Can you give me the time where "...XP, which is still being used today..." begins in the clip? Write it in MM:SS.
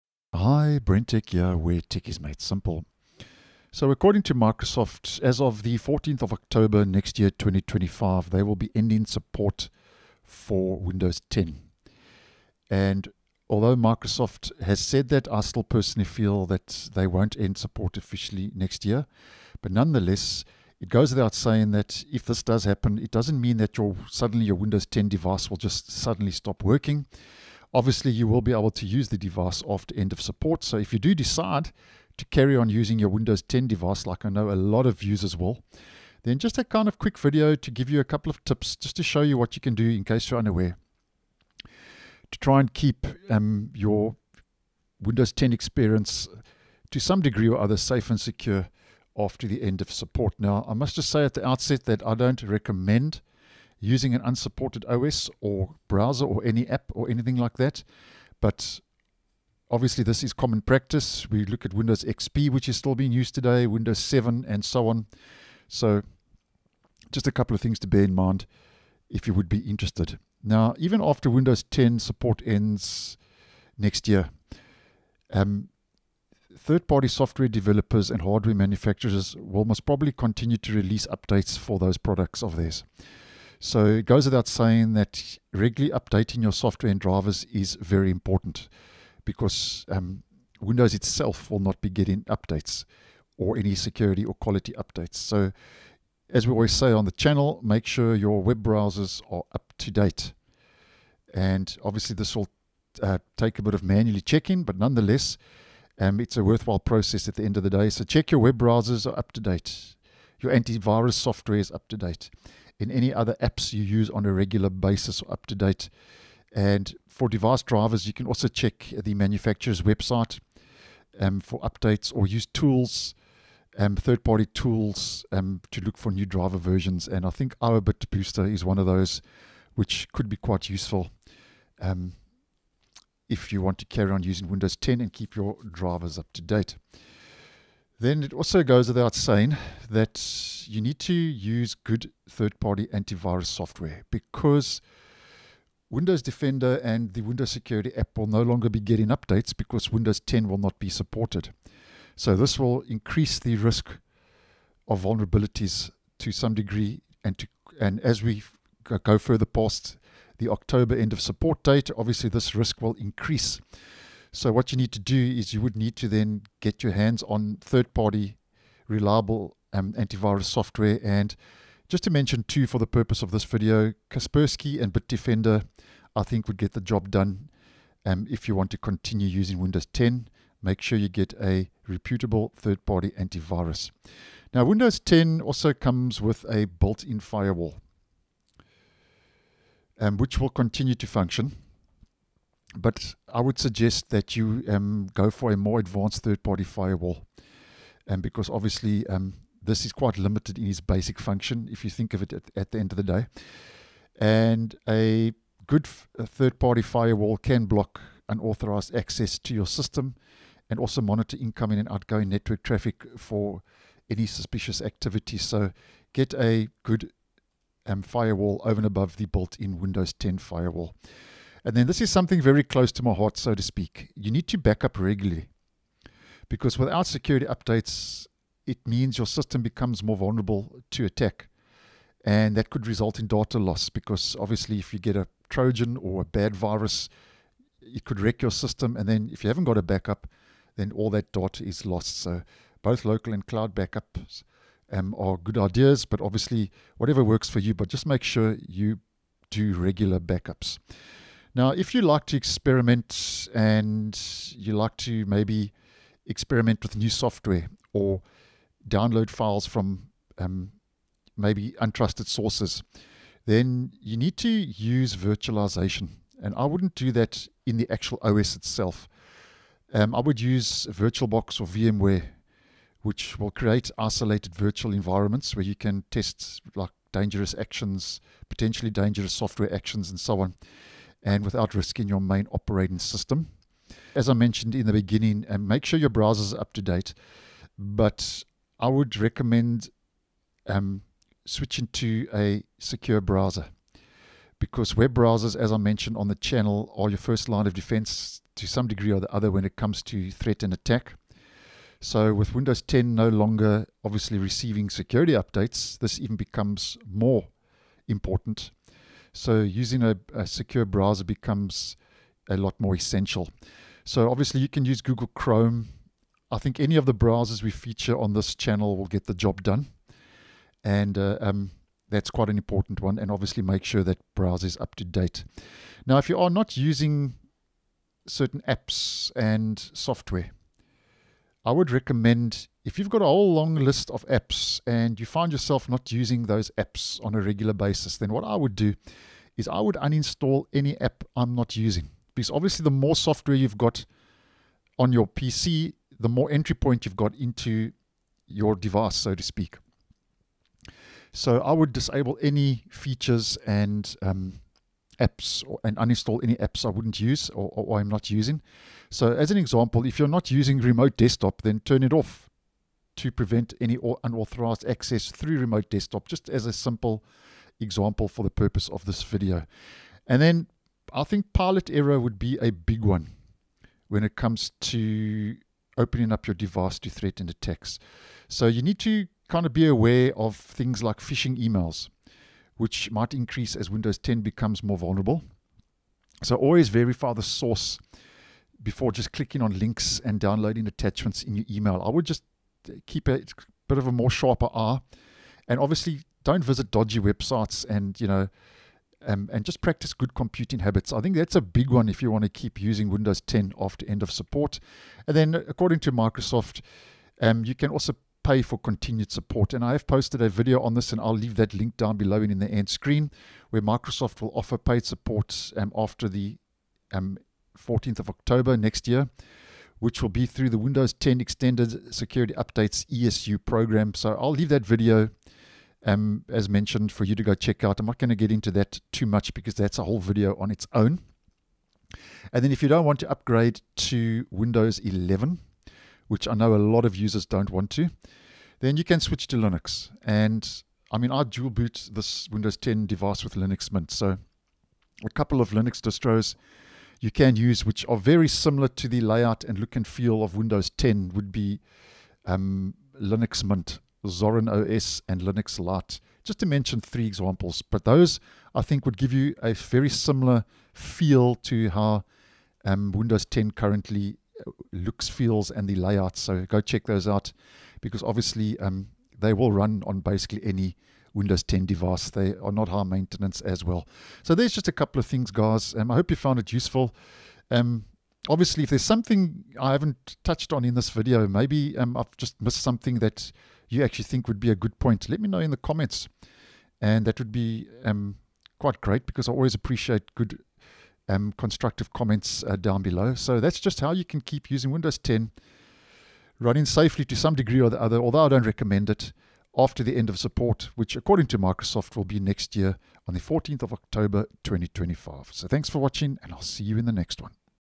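01:02.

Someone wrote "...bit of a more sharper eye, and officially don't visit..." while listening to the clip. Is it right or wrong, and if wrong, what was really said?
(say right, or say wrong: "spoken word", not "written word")
wrong: "obviously", not "officially".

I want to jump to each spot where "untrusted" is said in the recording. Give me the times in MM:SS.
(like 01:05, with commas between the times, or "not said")
04:21.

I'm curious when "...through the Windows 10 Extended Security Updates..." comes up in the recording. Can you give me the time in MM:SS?
07:00.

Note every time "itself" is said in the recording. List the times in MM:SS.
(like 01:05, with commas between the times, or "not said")
01:30, 04:28.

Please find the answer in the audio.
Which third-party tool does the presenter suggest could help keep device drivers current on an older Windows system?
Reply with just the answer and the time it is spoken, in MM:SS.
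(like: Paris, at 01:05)
IObit Booster, at 02:07.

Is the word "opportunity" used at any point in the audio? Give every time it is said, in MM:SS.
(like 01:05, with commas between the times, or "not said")
not said.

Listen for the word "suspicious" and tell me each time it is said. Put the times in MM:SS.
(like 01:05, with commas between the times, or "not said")
03:34.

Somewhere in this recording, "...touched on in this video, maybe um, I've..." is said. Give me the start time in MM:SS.
08:00.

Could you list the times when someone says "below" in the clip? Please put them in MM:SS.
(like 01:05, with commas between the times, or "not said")
06:52, 08:13.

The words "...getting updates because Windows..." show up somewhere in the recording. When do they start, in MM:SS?
02:28.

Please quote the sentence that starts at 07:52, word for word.
They are not high maintenance as well.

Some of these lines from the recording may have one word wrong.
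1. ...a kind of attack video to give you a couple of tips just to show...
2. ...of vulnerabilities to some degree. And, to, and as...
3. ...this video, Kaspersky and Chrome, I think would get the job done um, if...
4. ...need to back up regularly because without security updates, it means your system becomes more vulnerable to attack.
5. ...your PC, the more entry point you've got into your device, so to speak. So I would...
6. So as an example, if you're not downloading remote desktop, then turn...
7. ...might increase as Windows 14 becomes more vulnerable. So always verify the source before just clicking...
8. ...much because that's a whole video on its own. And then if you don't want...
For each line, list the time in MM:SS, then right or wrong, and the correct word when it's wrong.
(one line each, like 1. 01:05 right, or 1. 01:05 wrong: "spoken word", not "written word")
1. 00:36 wrong: "quick", not "attack"
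2. 02:34 right
3. 02:53 wrong: "Bitdefender", not "Chrome"
4. 03:44 right
5. 05:45 right
6. 05:59 wrong: "using", not "downloading"
7. 06:23 wrong: "10", not "14"
8. 07:09 right.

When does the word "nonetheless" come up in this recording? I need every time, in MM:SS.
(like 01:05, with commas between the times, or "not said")
00:19, 01:44.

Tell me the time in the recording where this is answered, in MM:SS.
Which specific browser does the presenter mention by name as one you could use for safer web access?
05:15.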